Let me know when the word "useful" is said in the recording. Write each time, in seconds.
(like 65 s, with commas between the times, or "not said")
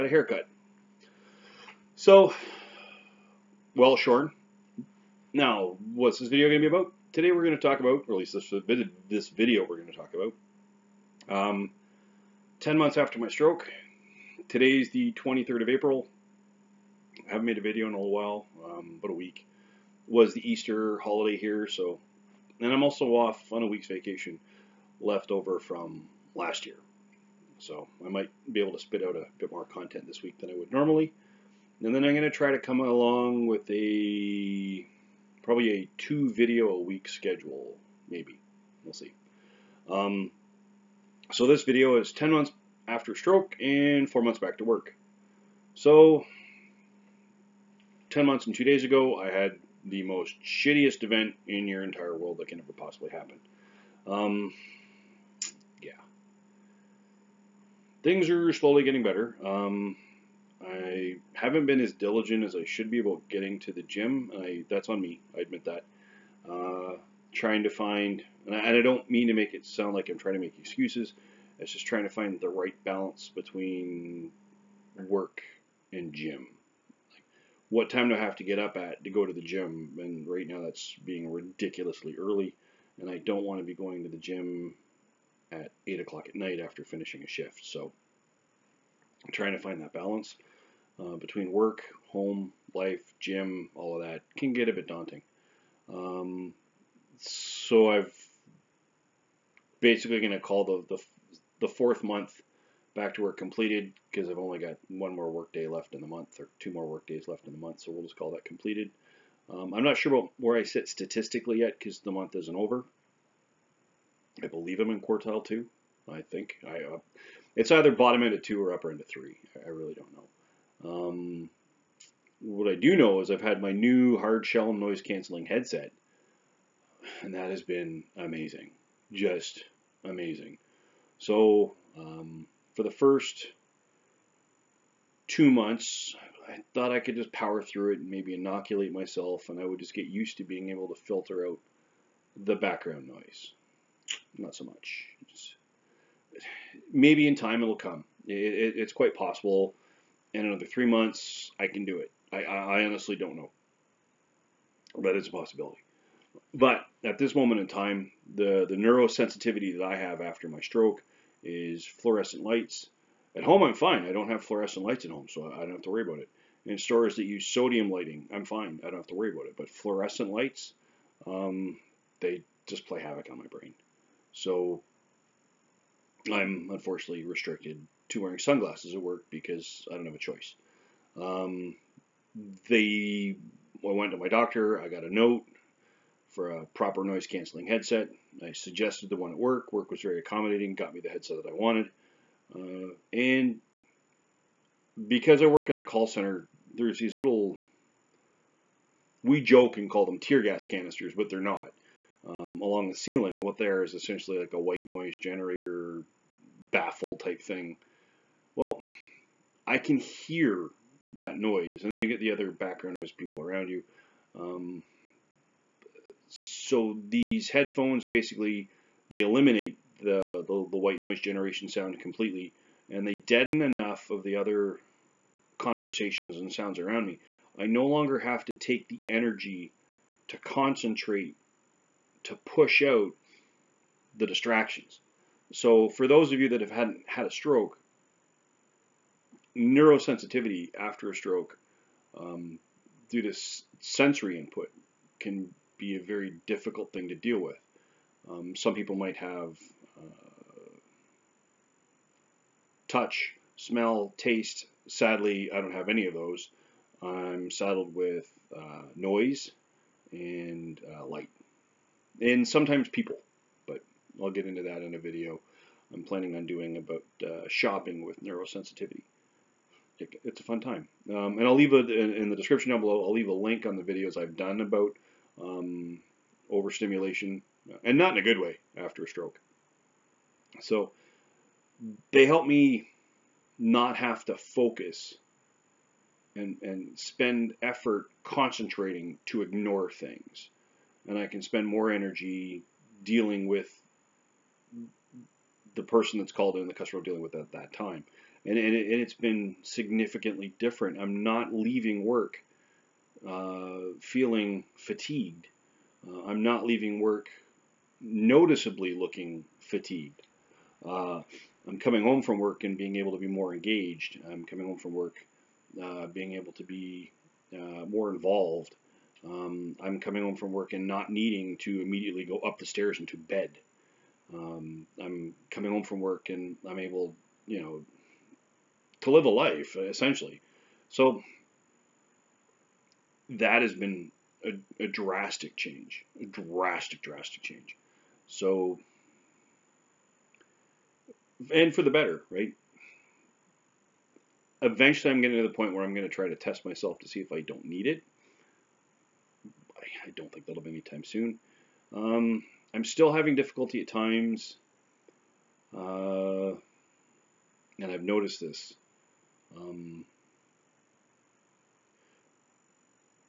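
not said.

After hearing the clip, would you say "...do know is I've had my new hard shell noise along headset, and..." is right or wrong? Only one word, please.
wrong.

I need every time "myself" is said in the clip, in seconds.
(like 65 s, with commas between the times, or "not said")
138 s, 346 s.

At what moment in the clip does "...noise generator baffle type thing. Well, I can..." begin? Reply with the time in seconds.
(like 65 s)
204 s.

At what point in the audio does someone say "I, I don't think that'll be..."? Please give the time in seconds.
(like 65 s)
349 s.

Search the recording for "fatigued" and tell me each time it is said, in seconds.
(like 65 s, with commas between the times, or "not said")
304 s, 309 s.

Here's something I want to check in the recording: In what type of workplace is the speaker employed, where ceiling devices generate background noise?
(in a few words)
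call center.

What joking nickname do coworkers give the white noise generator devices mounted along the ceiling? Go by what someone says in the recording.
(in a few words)
tear gas canisters.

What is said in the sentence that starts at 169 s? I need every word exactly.
But fluorescent lights, um, they just play havoc on my brain.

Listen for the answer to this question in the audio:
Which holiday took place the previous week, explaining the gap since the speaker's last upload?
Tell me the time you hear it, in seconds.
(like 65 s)
20 s.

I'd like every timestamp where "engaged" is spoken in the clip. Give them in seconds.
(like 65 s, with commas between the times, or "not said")
313 s.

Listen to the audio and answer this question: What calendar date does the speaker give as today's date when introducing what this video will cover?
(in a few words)
23 April.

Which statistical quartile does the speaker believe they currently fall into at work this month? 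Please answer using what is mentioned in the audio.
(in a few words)
quartile 2.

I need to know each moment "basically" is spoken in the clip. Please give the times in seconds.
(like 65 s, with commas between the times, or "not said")
99 s, 218 s.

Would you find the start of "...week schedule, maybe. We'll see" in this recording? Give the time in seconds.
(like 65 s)
36 s.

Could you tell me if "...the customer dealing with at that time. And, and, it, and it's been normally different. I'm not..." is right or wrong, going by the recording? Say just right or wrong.
wrong.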